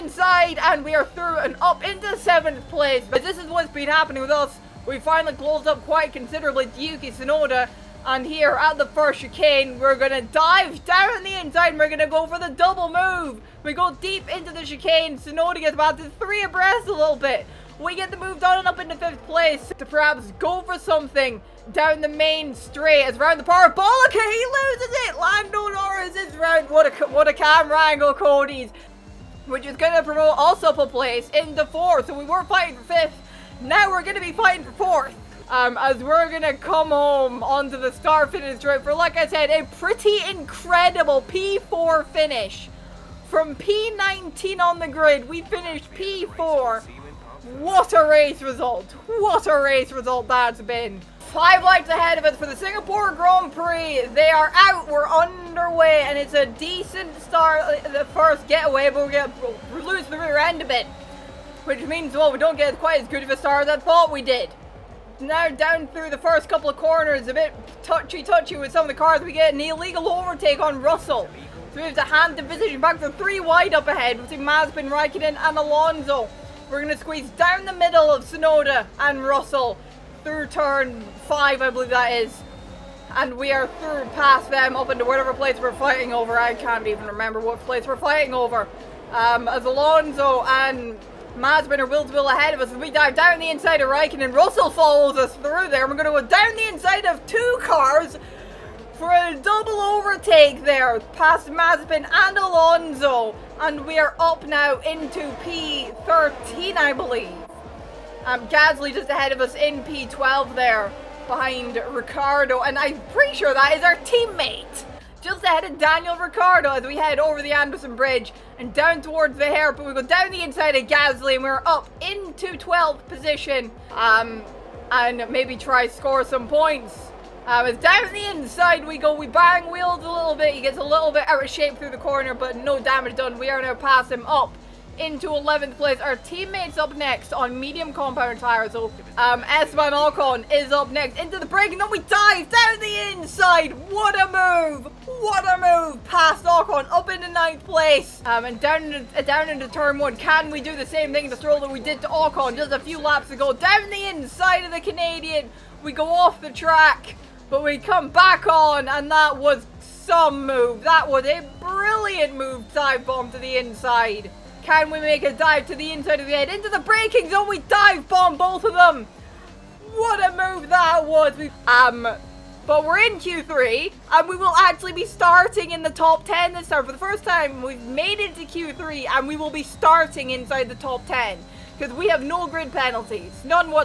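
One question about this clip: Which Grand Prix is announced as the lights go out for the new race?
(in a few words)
Singapore Grand Prix.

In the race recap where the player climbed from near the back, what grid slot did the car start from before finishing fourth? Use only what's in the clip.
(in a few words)
P19.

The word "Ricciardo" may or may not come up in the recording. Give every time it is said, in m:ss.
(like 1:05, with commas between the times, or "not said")
1:51, 1:56.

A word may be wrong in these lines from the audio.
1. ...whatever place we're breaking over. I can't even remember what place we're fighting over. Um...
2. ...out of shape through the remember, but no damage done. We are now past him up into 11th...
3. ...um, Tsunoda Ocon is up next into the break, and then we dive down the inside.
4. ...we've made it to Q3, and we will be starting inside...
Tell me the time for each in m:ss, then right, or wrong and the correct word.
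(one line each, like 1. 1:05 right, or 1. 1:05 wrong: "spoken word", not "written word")
1. 1:25 wrong: "fighting", not "breaking"
2. 2:11 wrong: "corner", not "remember"
3. 2:19 wrong: "Esteban", not "Tsunoda"
4. 2:57 right.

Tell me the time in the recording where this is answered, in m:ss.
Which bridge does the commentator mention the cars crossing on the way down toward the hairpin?
1:57.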